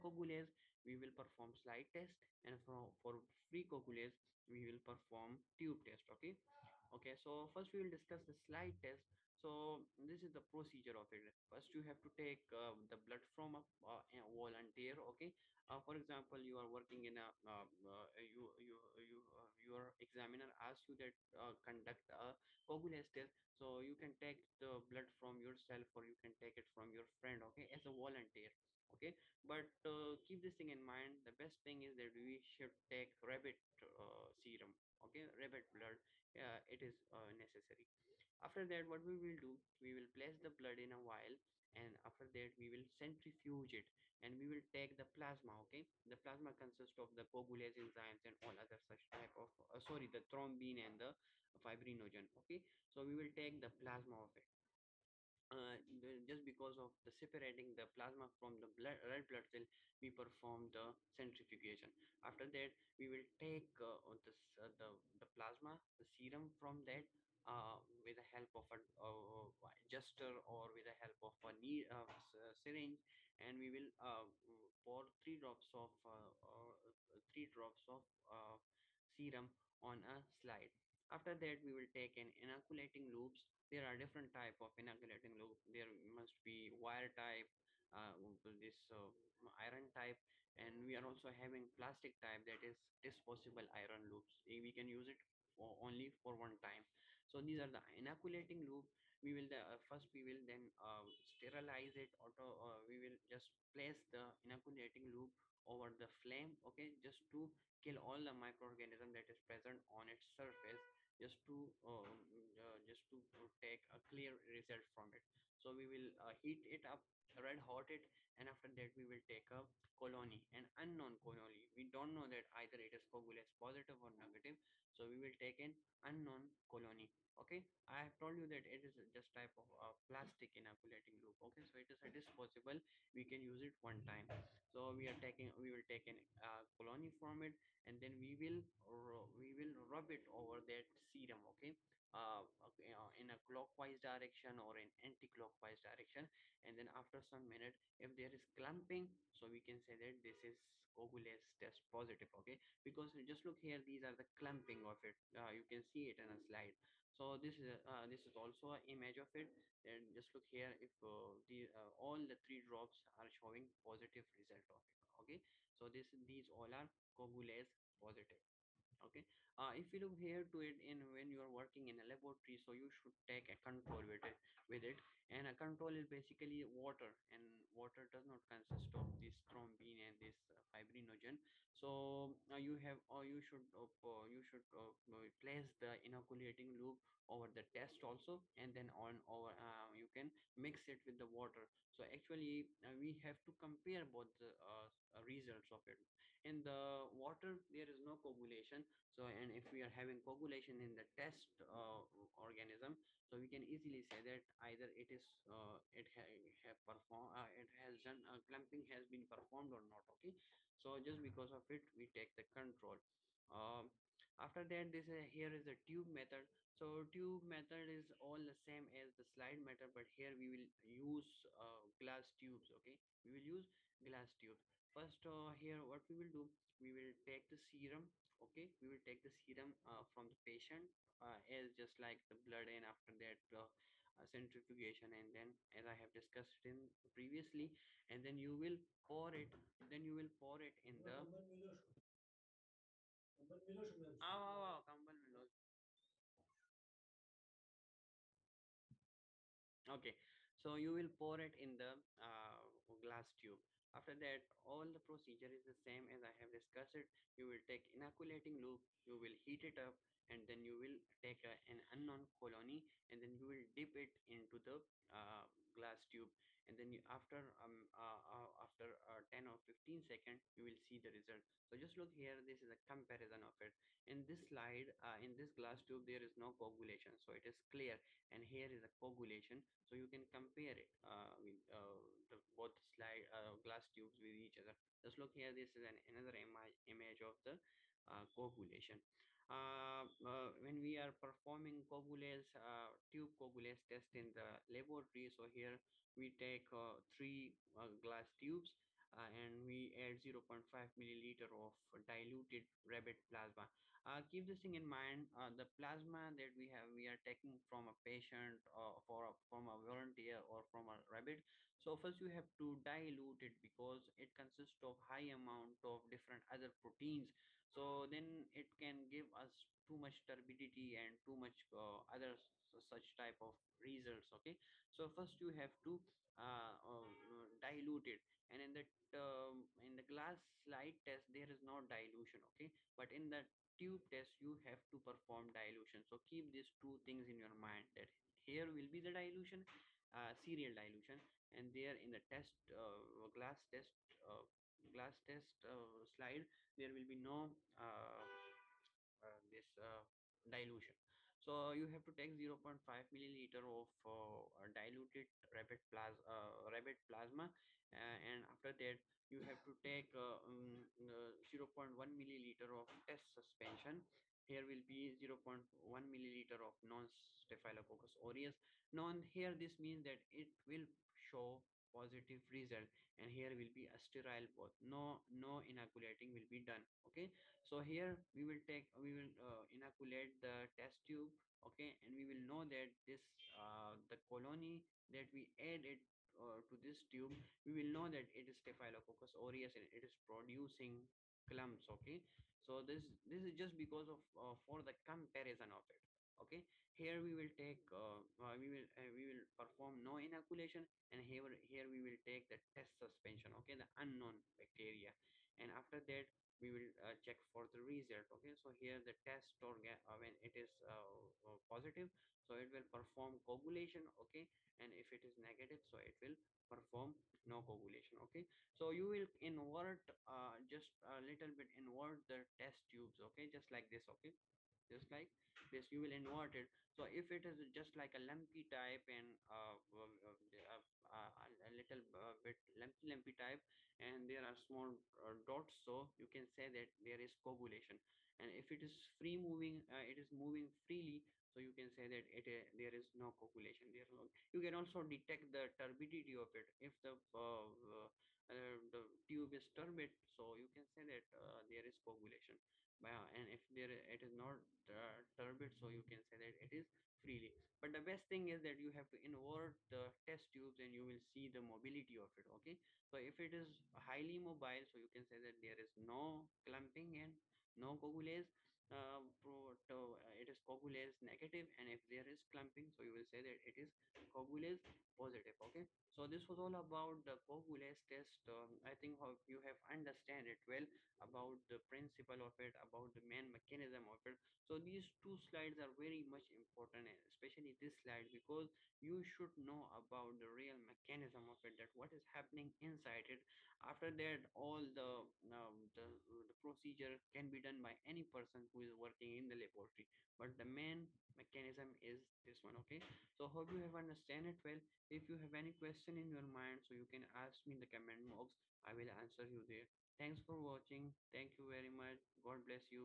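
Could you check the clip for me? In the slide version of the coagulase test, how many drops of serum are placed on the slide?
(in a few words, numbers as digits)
3.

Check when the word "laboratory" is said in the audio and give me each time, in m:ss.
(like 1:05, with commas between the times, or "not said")
2:52, 4:54, 8:19.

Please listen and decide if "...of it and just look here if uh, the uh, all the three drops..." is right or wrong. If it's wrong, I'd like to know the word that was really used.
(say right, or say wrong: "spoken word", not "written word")
right.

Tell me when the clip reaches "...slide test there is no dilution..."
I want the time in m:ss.
5:30.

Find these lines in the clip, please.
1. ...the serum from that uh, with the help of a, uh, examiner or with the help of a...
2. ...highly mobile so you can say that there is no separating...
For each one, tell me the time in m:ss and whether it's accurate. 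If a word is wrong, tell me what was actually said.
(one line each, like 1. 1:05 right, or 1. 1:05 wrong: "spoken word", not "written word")
1. 1:05 wrong: "adjuster", not "examiner"
2. 7:43 wrong: "clumping", not "separating".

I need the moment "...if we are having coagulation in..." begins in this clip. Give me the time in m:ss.
3:19.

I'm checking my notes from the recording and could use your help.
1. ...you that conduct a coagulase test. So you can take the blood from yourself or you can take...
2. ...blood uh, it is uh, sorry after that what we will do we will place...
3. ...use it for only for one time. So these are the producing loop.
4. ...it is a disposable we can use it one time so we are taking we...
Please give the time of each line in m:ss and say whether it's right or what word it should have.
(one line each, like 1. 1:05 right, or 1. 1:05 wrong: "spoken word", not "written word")
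1. 0:20 right
2. 0:35 wrong: "necessary", not "sorry"
3. 1:34 wrong: "inoculating", not "producing"
4. 2:11 right.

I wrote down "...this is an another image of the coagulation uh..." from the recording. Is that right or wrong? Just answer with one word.
right.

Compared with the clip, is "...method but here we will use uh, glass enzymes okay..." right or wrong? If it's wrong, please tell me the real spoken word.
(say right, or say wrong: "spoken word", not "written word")
wrong: "tubes", not "enzymes".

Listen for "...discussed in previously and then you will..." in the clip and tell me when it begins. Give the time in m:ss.
3:56.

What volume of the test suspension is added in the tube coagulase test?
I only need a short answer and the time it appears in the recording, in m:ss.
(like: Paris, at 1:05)
0.1 milliliter, at 6:01.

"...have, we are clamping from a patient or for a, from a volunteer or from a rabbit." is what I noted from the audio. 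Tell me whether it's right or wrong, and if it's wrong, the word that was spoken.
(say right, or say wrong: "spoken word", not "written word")
wrong: "taking", not "clamping".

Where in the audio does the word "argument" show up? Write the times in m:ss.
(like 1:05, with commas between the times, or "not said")
not said.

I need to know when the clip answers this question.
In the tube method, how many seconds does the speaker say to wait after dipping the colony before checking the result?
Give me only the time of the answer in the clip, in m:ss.
4:29.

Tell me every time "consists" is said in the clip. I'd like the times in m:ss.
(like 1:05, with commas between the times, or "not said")
0:46, 2:58, 5:14.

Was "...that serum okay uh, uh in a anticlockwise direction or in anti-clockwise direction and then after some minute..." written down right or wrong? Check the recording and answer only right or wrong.
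wrong.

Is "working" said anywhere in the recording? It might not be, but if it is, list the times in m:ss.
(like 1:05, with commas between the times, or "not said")
0:16, 2:51, 8:18.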